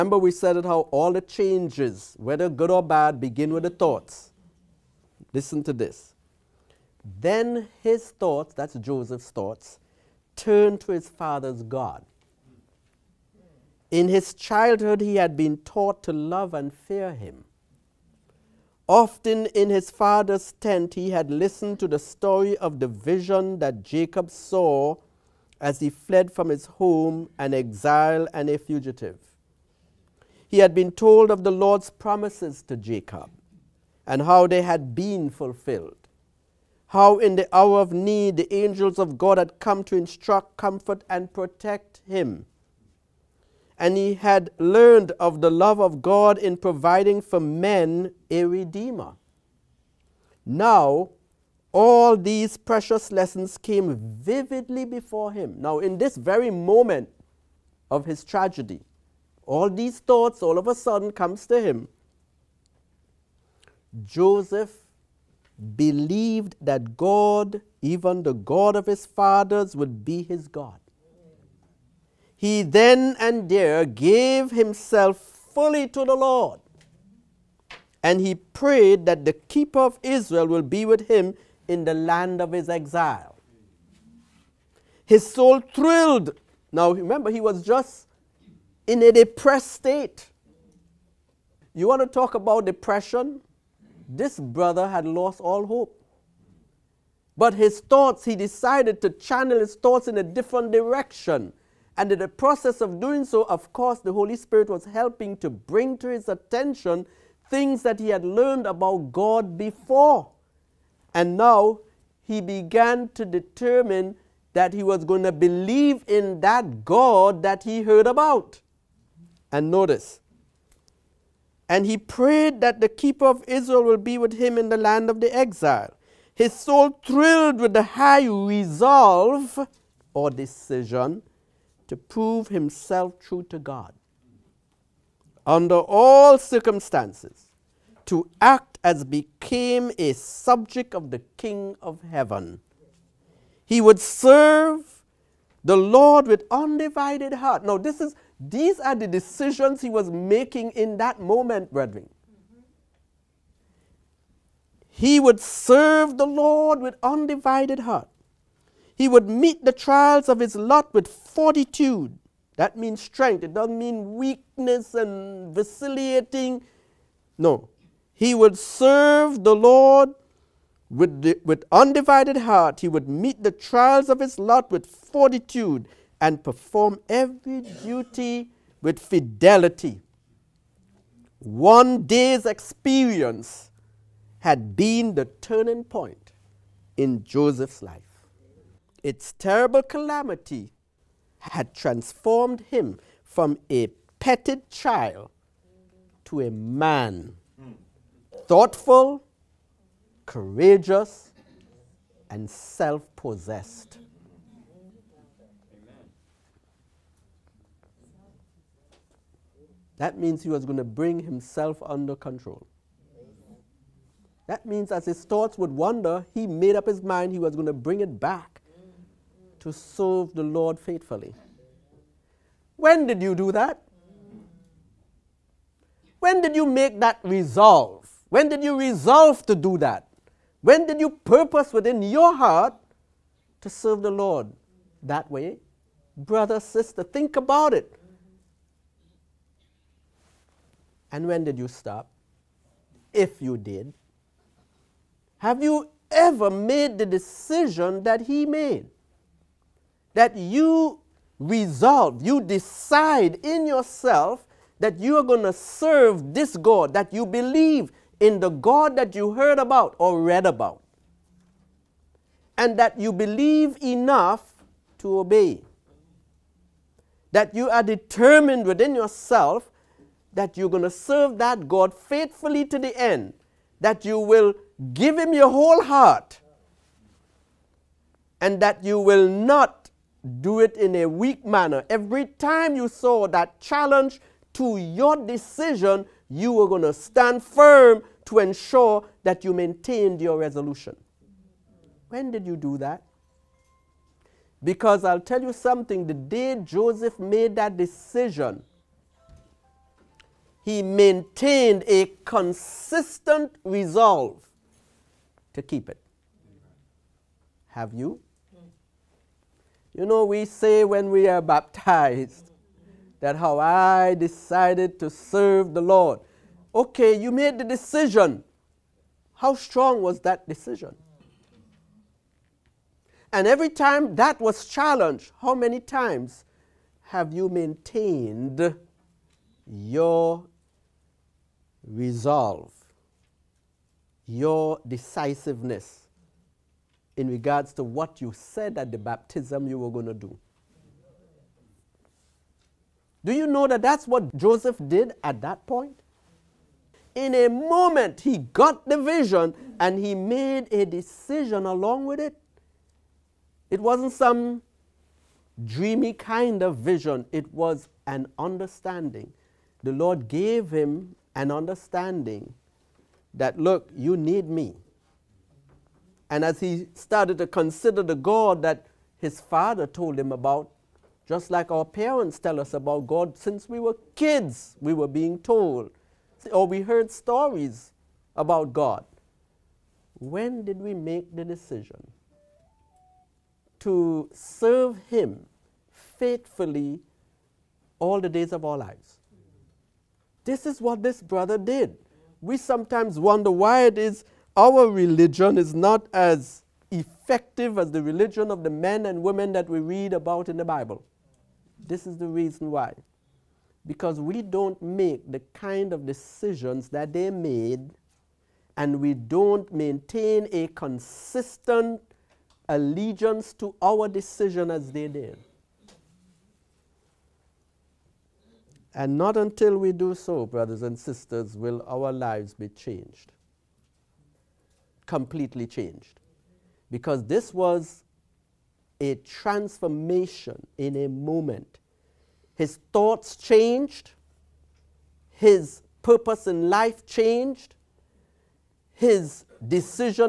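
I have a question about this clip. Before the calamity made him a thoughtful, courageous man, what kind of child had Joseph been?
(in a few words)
A petted child.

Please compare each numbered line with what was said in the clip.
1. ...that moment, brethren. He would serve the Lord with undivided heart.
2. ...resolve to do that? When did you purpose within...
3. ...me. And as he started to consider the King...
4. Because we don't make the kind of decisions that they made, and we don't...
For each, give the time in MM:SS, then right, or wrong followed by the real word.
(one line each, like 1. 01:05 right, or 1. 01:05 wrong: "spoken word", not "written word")
1. 02:30 right
2. 03:48 right
3. 06:04 wrong: "God", not "King"
4. 06:43 right.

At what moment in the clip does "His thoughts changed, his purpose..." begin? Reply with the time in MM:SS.
07:12.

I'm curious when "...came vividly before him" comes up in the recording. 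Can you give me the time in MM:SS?
00:53.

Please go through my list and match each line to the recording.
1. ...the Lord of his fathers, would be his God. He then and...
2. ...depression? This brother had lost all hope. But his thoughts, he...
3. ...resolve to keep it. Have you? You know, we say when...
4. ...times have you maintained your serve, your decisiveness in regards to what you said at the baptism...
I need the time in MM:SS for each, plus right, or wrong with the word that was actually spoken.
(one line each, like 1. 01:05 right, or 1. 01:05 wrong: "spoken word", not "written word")
1. 01:08 wrong: "God", not "Lord"
2. 01:32 right
3. 05:03 right
4. 05:25 wrong: "resolve", not "serve".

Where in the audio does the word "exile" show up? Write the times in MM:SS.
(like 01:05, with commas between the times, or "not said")
00:27, 01:22, 02:05.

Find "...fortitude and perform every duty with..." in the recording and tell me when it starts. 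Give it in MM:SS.
02:54.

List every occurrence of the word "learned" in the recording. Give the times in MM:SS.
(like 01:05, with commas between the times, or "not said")
00:44, 01:48.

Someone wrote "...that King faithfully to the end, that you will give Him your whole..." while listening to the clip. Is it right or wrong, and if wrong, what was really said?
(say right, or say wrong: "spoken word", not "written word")
wrong: "God", not "King".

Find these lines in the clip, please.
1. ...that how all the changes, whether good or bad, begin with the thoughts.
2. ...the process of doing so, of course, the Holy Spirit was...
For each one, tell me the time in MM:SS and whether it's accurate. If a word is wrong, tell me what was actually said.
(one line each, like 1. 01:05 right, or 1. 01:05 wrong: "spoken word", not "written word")
1. 00:00 right
2. 01:42 right.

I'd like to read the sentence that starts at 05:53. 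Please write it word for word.
It wasn't some dreamy kind of vision, it was an understanding.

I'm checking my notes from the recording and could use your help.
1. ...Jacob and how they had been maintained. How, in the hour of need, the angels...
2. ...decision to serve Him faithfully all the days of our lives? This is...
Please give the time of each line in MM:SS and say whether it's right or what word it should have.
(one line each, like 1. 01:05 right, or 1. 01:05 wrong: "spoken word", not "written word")
1. 00:32 wrong: "fulfilled", not "maintained"
2. 06:21 right.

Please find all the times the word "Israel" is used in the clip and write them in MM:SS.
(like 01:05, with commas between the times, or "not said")
01:20, 02:03.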